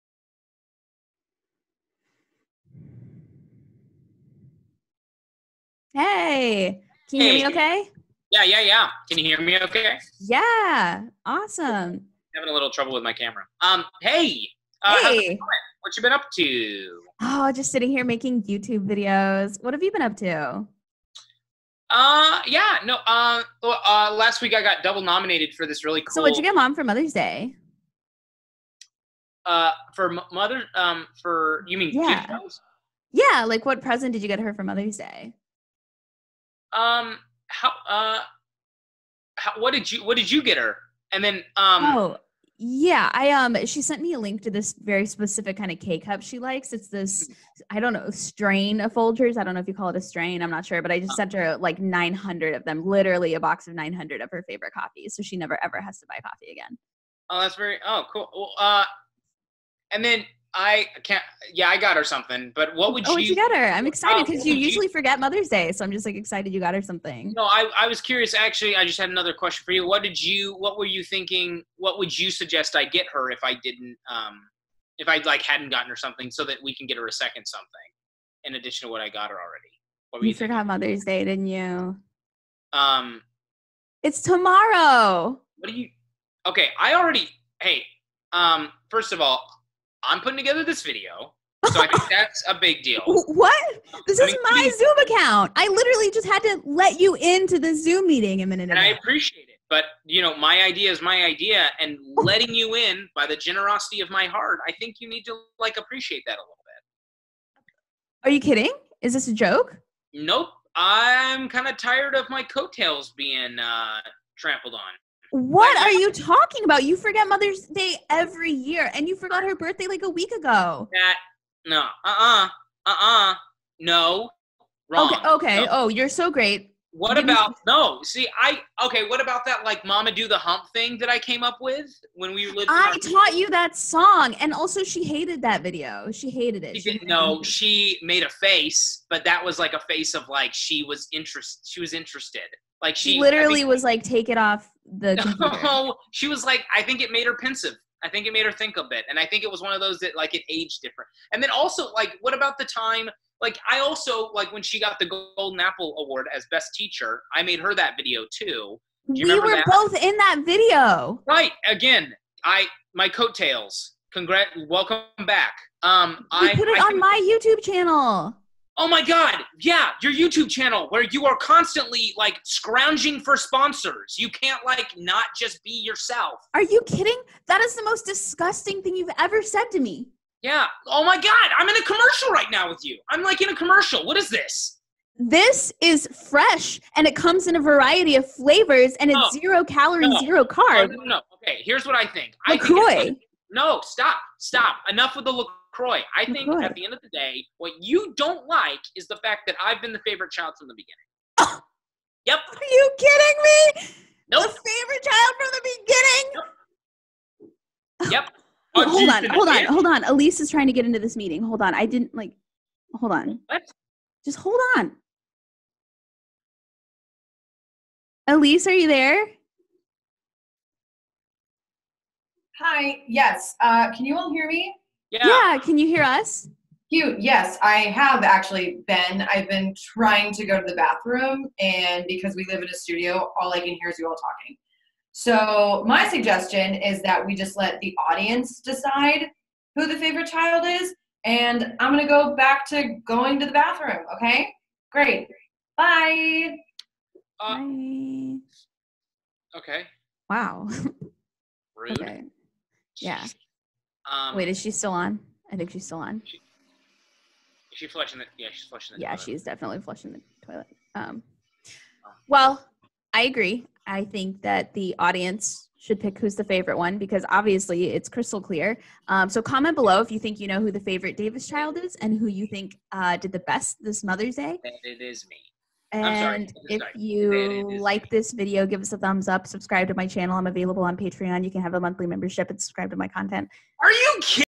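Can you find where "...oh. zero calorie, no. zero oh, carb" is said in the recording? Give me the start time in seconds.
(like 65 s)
189 s.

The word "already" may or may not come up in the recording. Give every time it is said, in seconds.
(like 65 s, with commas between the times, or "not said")
79 s, 86 s.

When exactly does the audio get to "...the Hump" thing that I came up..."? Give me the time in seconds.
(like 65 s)
130 s.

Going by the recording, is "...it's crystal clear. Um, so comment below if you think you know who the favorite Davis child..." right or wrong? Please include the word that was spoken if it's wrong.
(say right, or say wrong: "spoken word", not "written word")
right.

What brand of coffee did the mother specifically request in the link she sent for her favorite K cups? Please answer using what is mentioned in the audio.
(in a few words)
Folgers.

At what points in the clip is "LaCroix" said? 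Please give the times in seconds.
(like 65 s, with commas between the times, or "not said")
192 s.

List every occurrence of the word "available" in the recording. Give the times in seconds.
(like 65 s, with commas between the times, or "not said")
280 s.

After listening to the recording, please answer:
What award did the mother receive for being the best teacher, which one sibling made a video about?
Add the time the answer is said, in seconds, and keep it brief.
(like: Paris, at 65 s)
Golden Apple Award, at 155 s.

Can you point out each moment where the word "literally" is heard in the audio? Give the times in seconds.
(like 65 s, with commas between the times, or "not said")
52 s, 95 s, 143 s.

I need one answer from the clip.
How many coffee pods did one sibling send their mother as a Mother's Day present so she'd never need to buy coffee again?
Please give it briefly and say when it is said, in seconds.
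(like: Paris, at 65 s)
900, at 52 s.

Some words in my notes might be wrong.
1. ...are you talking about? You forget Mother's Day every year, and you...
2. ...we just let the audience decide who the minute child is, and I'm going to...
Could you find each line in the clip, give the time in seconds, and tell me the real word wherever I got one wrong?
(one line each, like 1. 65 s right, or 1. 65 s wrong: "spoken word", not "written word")
1. 115 s right
2. 237 s wrong: "favorite", not "minute".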